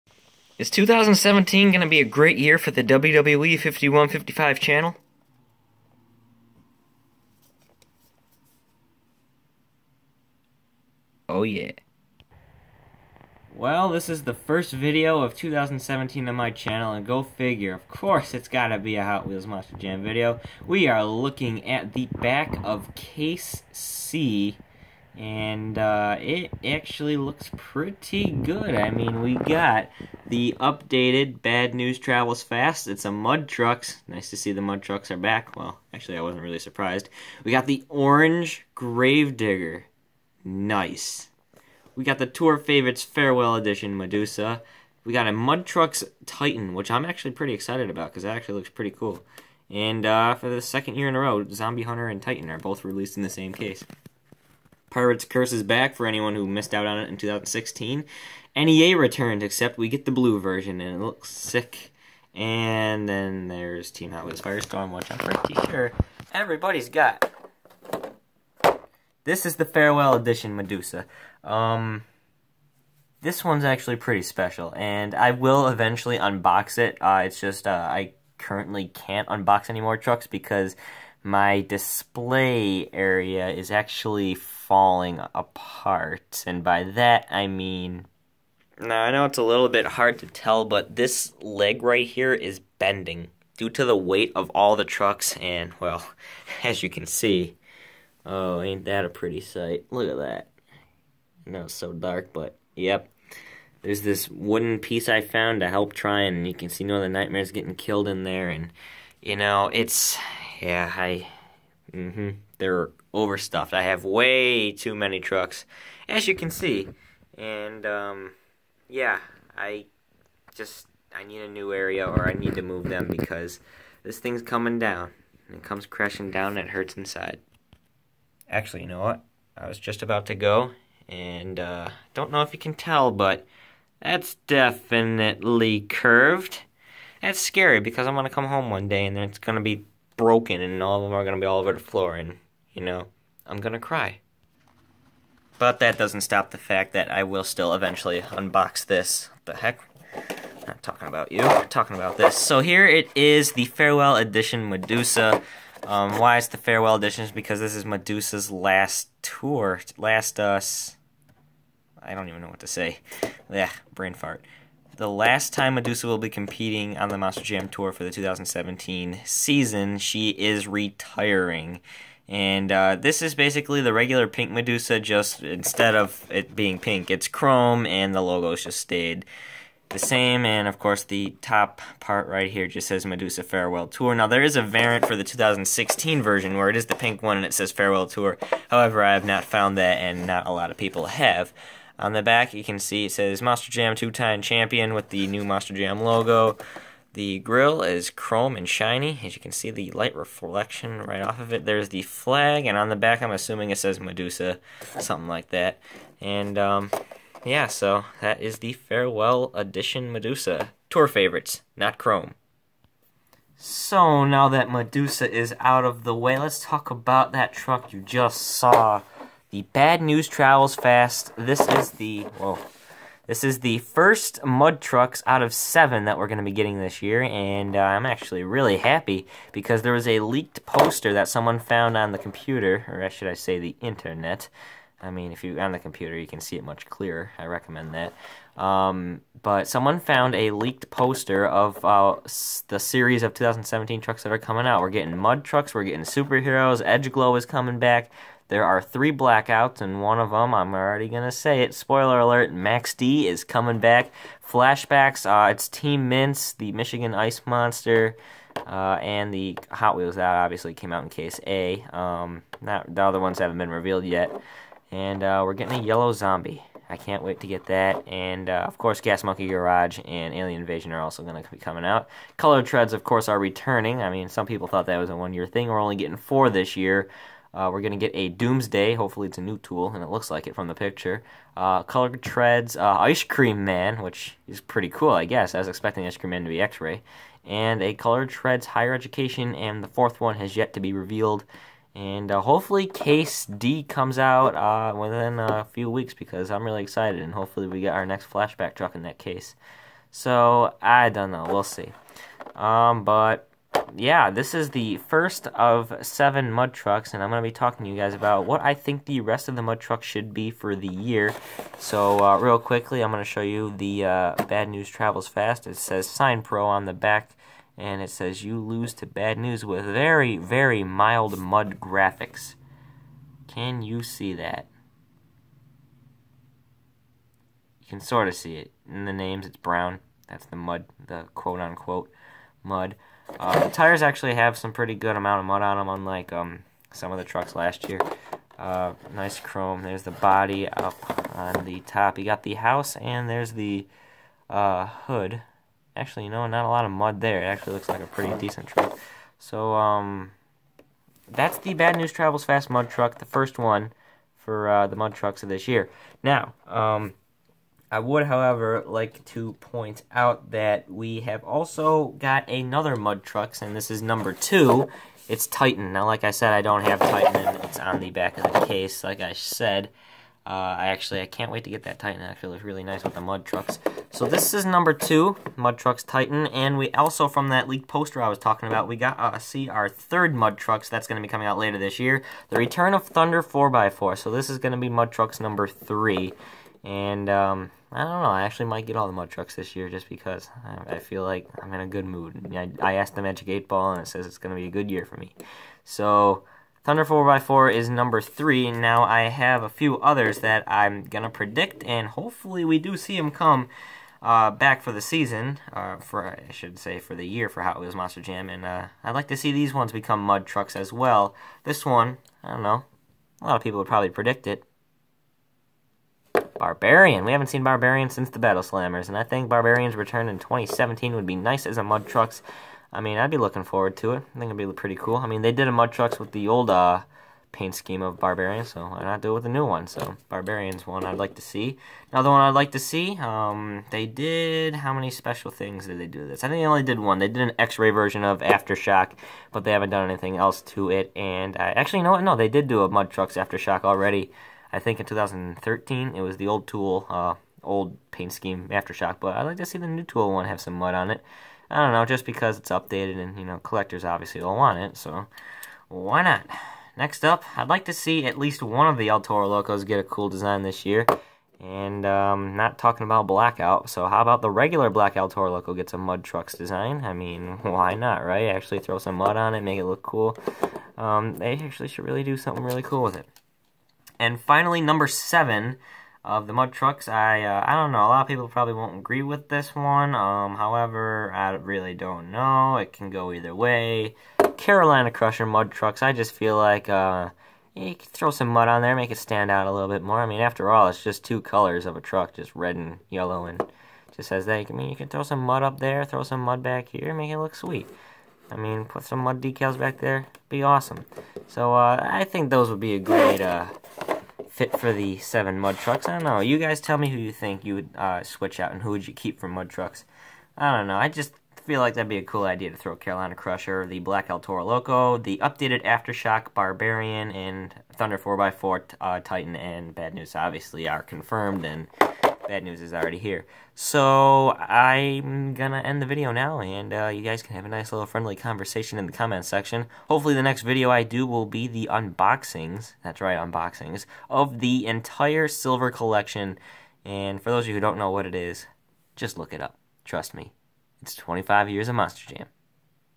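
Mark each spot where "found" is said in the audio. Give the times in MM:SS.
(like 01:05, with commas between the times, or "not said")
01:45, 03:09, 03:51, 04:00.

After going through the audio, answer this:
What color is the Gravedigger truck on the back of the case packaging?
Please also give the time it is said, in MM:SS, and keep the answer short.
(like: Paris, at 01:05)
Orange, at 00:37.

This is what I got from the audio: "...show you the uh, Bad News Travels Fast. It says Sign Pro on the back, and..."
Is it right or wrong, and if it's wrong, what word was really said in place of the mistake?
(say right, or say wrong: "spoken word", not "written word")
right.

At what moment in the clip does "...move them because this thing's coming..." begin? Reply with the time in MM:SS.
02:02.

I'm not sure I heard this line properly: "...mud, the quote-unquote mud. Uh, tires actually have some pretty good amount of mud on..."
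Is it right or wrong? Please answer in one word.
right.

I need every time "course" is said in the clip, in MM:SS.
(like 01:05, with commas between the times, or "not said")
00:17, 03:00, 04:28, 04:33.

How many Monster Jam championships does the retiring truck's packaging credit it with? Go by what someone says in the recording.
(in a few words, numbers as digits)
2.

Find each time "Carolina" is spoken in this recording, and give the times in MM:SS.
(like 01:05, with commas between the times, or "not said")
08:04, 08:32.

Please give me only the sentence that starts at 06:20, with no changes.
That's going to be coming out later this year.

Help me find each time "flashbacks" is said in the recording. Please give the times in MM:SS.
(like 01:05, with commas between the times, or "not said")
04:14, 04:58.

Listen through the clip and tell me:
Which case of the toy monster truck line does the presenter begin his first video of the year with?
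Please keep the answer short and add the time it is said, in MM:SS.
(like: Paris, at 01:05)
Case C, at 00:22.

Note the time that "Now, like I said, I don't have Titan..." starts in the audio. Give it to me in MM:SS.
06:05.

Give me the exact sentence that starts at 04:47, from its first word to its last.
And a Color Treads Higher Education, and the fourth one has yet to be revealed.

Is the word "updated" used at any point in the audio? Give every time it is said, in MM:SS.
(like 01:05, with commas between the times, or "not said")
00:30, 07:32, 08:35.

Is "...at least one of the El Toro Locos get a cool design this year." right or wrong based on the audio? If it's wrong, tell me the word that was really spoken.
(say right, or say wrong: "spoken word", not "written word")
right.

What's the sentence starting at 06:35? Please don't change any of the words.
So, Thunder 4x4 is number 3.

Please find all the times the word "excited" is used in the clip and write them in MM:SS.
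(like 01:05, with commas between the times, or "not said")
00:47, 04:56.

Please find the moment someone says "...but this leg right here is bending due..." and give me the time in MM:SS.
01:30.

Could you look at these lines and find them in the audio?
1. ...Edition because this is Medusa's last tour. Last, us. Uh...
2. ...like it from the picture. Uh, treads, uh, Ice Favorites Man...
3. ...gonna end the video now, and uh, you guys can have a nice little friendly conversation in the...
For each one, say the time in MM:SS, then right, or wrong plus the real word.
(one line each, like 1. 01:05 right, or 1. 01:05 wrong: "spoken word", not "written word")
1. 02:36 right
2. 04:40 wrong: "Cream", not "Favorites"
3. 08:45 right.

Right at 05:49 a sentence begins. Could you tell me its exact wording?
So, um, that's the Bad News Travels Fast mud truck, the first one for uh, the mud trucks of this year.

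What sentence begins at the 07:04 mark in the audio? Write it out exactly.
I think it'd be pretty cool.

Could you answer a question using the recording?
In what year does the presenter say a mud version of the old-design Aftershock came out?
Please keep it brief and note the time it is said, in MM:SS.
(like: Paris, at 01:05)
2013, at 07:25.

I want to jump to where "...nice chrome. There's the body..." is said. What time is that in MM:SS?
05:39.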